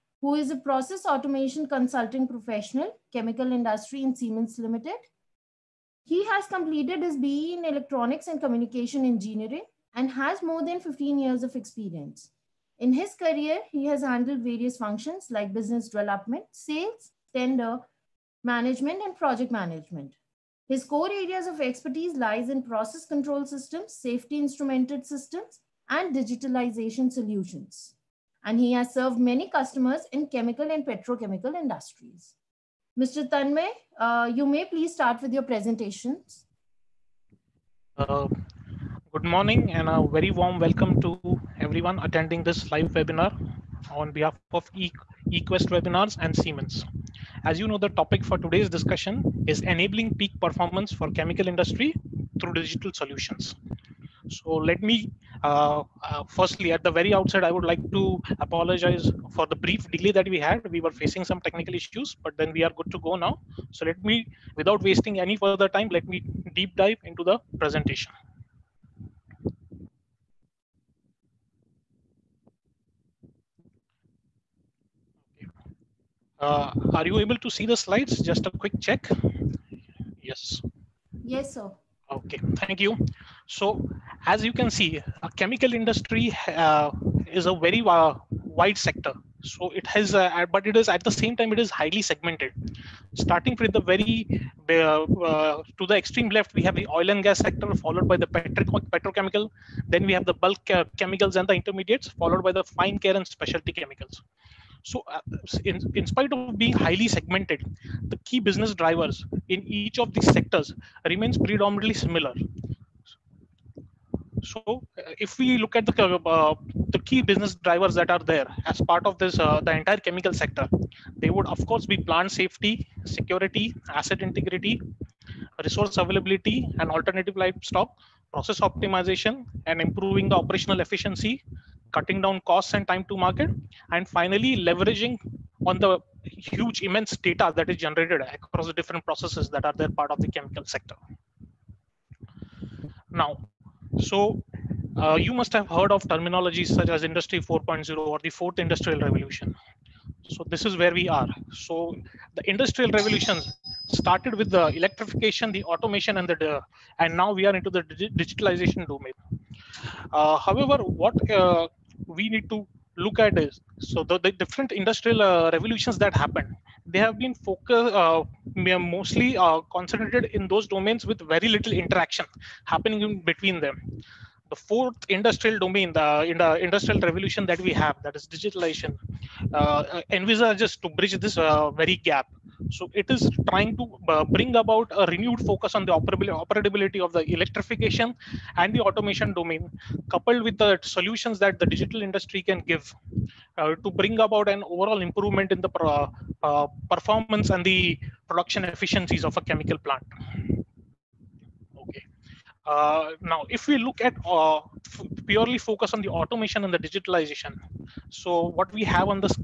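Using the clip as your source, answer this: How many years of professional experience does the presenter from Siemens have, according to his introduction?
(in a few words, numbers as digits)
15.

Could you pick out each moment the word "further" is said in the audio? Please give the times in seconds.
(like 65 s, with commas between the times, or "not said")
65 s.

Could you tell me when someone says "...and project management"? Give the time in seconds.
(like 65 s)
19 s.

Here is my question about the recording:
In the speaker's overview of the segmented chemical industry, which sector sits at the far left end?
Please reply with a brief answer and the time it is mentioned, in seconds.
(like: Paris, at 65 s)
Oil and gas, at 96 s.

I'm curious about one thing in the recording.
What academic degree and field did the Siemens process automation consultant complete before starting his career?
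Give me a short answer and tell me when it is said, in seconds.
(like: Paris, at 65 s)
BE in Electronics and Communication Engineering, at 7 s.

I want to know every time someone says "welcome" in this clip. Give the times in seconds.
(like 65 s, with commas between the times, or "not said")
40 s.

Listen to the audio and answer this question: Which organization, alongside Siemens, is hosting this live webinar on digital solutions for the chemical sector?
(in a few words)
eQuest Webinars.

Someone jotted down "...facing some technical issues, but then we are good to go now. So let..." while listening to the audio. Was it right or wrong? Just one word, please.
right.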